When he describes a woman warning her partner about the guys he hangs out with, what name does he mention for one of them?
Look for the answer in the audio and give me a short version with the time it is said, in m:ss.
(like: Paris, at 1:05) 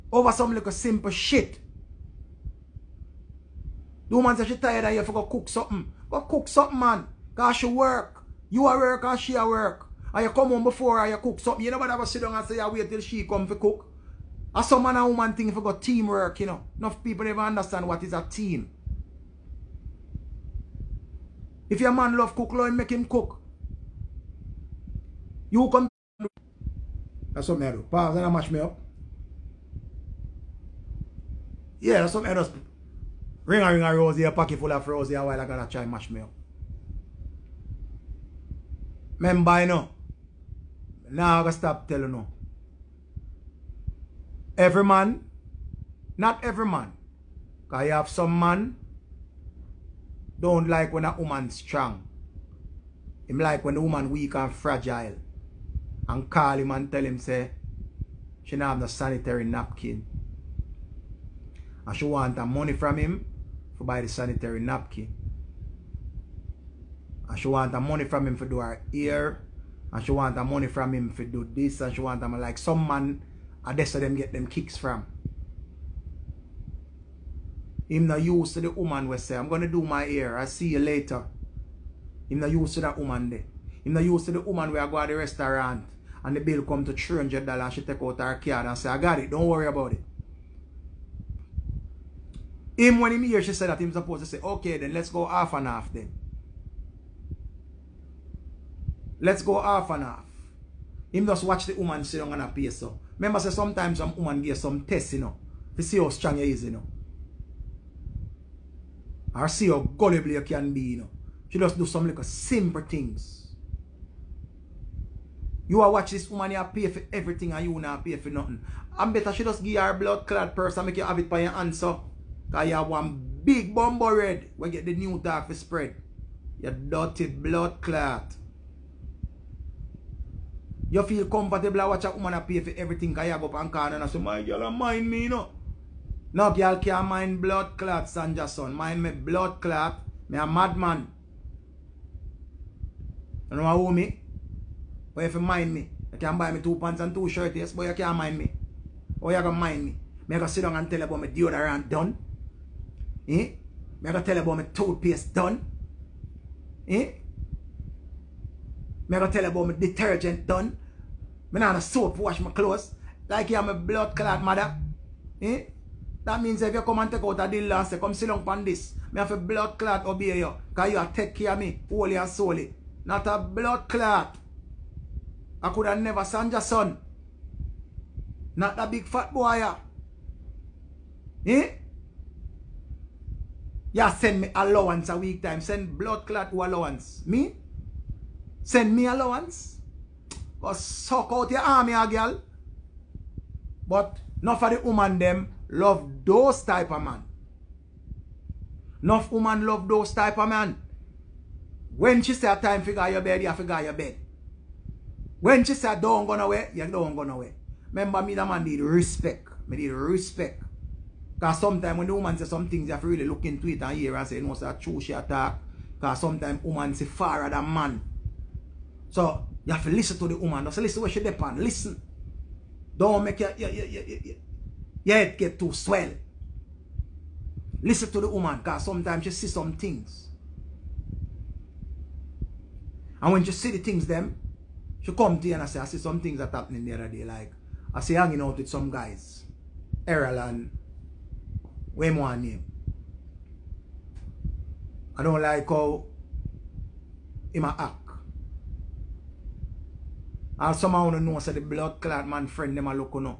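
Errol, at 4:00.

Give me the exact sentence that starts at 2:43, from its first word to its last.
Like you have my blood clot mother.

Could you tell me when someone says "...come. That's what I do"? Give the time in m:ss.
0:25.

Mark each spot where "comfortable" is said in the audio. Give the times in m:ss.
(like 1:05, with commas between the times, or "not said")
2:11.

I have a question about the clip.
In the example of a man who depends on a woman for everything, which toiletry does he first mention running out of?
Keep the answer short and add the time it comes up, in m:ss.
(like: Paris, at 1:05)
deodorant, at 2:31.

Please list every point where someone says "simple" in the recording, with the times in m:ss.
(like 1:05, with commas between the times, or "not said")
0:00, 1:52.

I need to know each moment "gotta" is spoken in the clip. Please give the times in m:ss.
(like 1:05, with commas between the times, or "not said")
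0:35, 0:41.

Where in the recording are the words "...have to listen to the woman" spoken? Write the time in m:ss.
3:39.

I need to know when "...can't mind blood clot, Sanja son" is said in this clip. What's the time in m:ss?
2:16.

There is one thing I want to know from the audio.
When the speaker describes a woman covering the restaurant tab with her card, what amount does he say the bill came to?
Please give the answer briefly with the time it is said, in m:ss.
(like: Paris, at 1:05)
$300, at 1:26.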